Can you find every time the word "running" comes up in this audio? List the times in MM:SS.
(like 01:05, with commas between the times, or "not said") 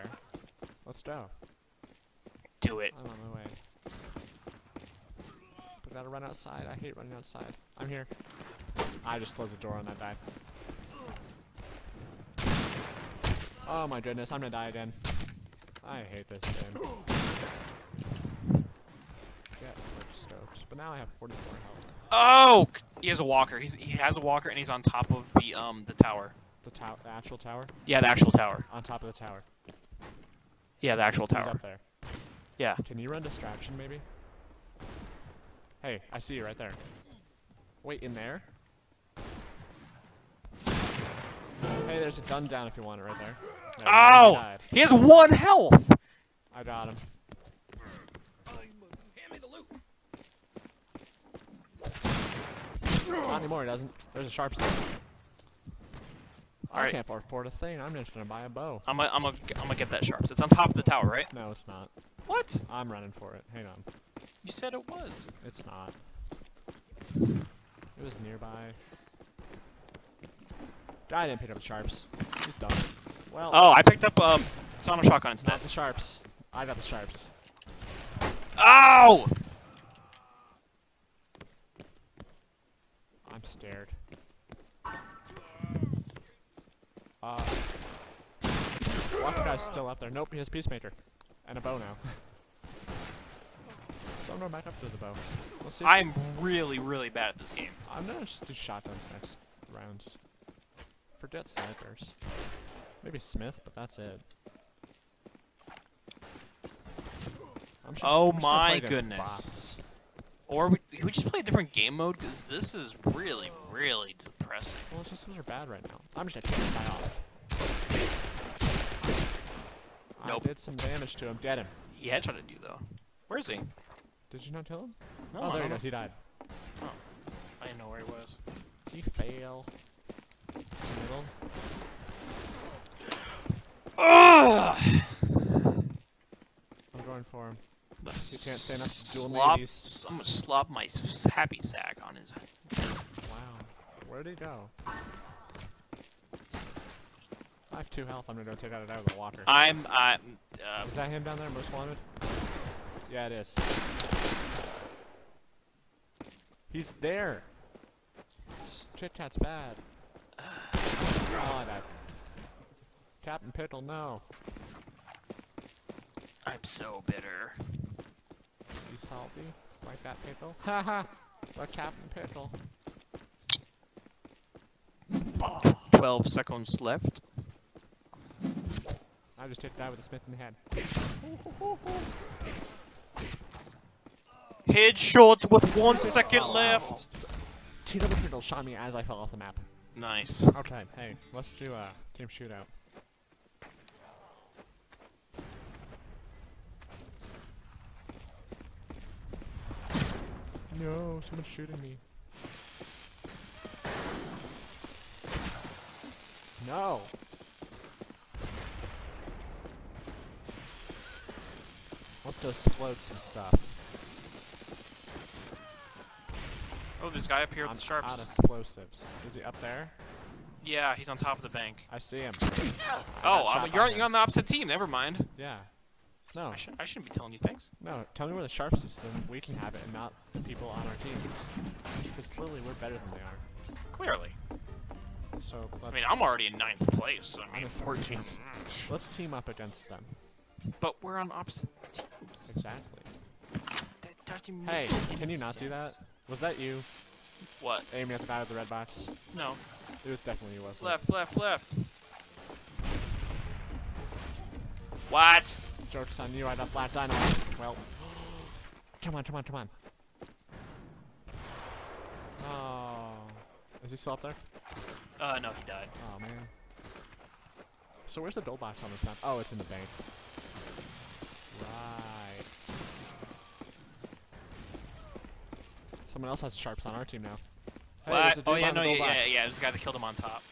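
00:06, 01:02.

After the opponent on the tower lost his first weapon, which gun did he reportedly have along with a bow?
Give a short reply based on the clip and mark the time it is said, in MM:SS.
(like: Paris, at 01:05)
Peacemaker, at 01:30.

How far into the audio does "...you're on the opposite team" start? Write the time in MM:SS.
03:43.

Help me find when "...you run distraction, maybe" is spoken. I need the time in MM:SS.
00:32.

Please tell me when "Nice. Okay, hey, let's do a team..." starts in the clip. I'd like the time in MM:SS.
03:09.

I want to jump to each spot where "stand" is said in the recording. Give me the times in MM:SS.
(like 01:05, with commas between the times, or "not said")
02:18.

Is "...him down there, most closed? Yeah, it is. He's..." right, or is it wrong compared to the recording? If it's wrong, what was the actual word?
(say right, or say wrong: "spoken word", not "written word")
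wrong: "wanted", not "closed".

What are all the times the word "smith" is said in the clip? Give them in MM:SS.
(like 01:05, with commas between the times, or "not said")
01:43, 03:00.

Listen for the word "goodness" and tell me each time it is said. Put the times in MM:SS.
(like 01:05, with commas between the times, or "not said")
00:14, 01:48.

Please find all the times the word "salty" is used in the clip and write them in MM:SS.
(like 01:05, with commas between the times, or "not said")
02:49.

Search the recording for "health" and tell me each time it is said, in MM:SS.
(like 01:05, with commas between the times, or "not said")
00:21, 00:45, 02:28.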